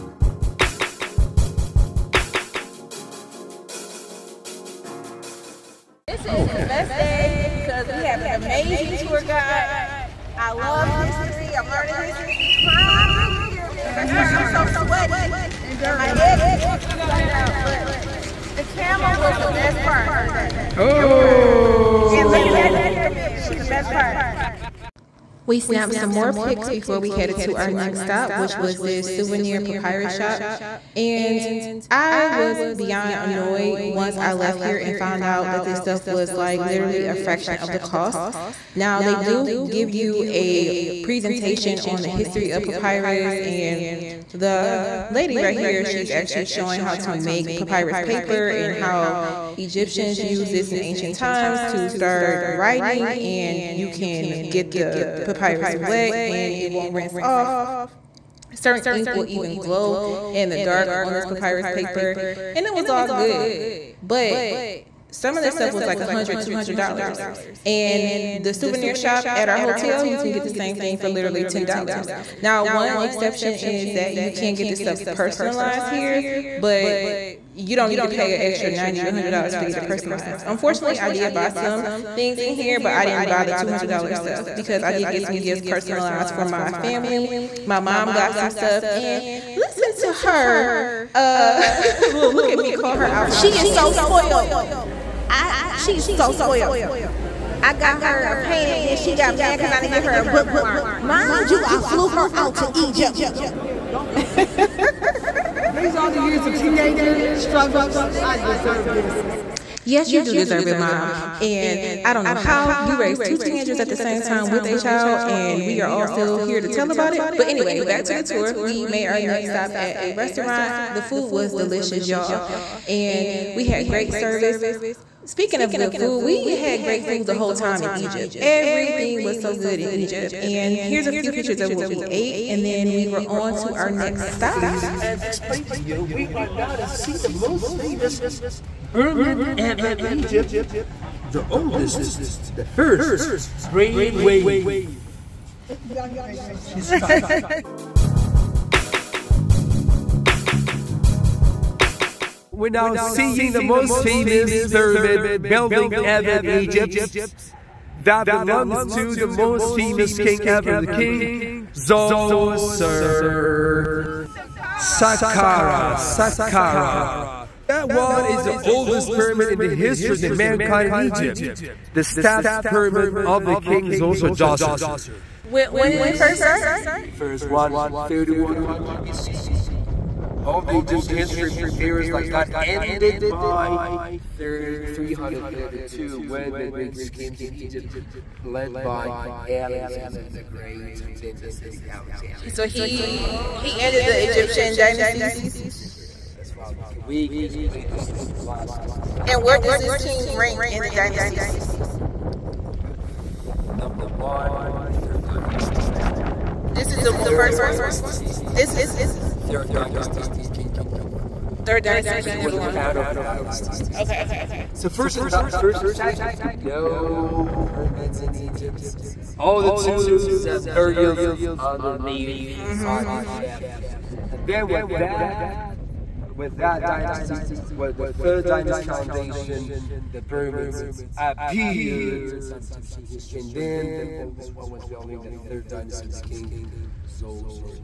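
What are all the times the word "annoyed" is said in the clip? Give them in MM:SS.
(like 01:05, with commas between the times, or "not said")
00:33.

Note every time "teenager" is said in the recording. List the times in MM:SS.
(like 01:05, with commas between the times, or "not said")
01:46, 01:53.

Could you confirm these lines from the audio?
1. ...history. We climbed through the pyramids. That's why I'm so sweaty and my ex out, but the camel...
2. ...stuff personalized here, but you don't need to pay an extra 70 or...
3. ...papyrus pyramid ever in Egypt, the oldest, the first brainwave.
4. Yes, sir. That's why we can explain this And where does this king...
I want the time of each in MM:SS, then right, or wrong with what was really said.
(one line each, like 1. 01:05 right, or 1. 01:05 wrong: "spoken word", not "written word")
1. 00:11 right
2. 01:14 wrong: "90", not "70"
3. 02:17 wrong: "famous", not "papyrus"
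4. 03:15 right.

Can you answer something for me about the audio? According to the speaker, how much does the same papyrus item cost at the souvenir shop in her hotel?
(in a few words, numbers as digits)
$10.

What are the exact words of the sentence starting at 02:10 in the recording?
And here's a few pictures of what we ate, and then we were on to our next stop.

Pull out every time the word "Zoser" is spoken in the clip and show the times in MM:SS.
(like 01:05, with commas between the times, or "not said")
02:41, 02:53.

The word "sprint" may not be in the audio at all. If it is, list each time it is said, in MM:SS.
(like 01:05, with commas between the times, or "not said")
not said.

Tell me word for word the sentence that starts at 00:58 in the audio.
Certain ink will even glow in the dark on this papyrus paper and it was all good.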